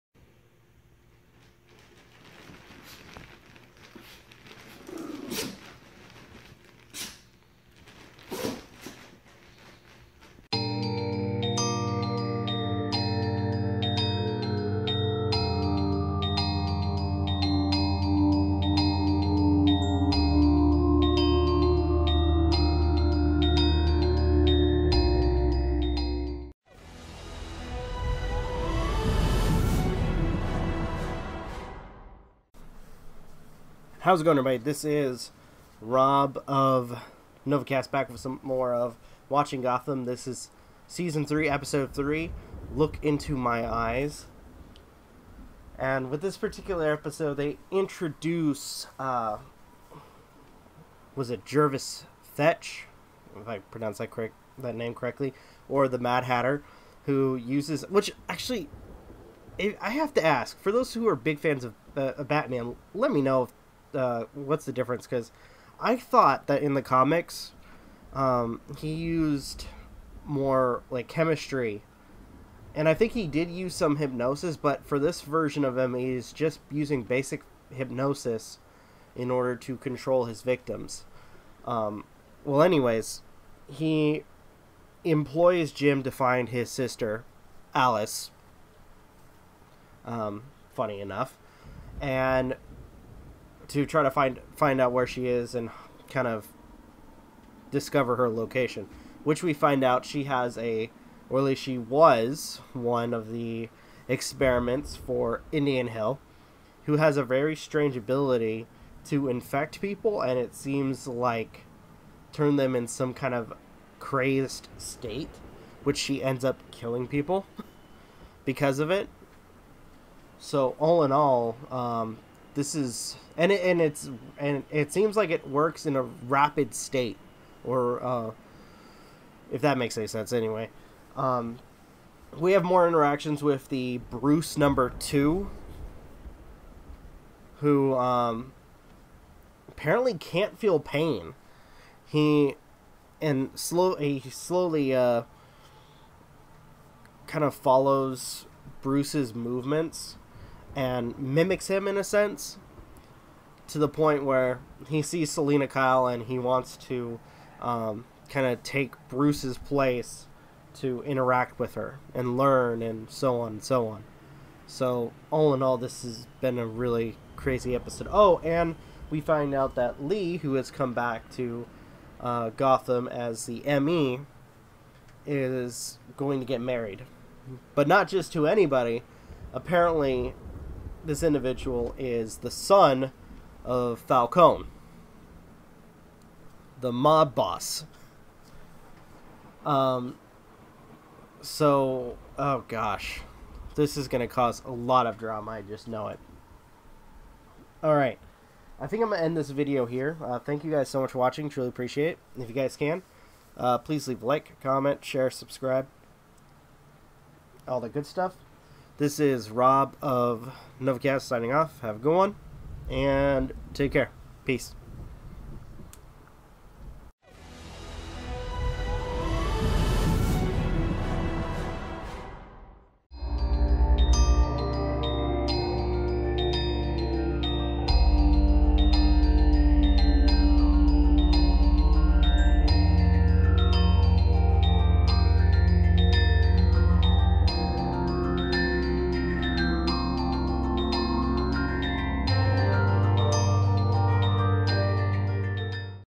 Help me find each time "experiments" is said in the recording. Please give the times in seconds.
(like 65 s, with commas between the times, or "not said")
104 s.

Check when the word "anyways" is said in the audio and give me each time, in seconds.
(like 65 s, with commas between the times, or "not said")
82 s, 130 s.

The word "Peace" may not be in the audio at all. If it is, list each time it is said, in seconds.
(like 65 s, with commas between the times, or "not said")
214 s.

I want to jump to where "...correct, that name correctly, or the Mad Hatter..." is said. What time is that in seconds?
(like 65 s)
54 s.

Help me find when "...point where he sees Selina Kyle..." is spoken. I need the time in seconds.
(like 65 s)
153 s.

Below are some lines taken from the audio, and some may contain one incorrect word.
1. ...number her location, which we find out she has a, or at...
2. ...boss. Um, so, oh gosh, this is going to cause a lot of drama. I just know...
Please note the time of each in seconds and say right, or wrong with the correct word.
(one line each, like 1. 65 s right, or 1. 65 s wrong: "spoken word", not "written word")
1. 97 s wrong: "discover", not "number"
2. 187 s right.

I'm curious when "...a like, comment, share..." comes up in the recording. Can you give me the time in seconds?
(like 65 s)
204 s.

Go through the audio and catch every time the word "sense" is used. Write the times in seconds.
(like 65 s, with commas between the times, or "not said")
130 s, 152 s.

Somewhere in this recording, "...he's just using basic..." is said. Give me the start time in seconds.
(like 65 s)
75 s.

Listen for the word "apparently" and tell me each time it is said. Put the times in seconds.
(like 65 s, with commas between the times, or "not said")
139 s, 179 s.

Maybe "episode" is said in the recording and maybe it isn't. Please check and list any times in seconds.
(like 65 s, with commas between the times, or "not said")
41 s, 46 s, 167 s.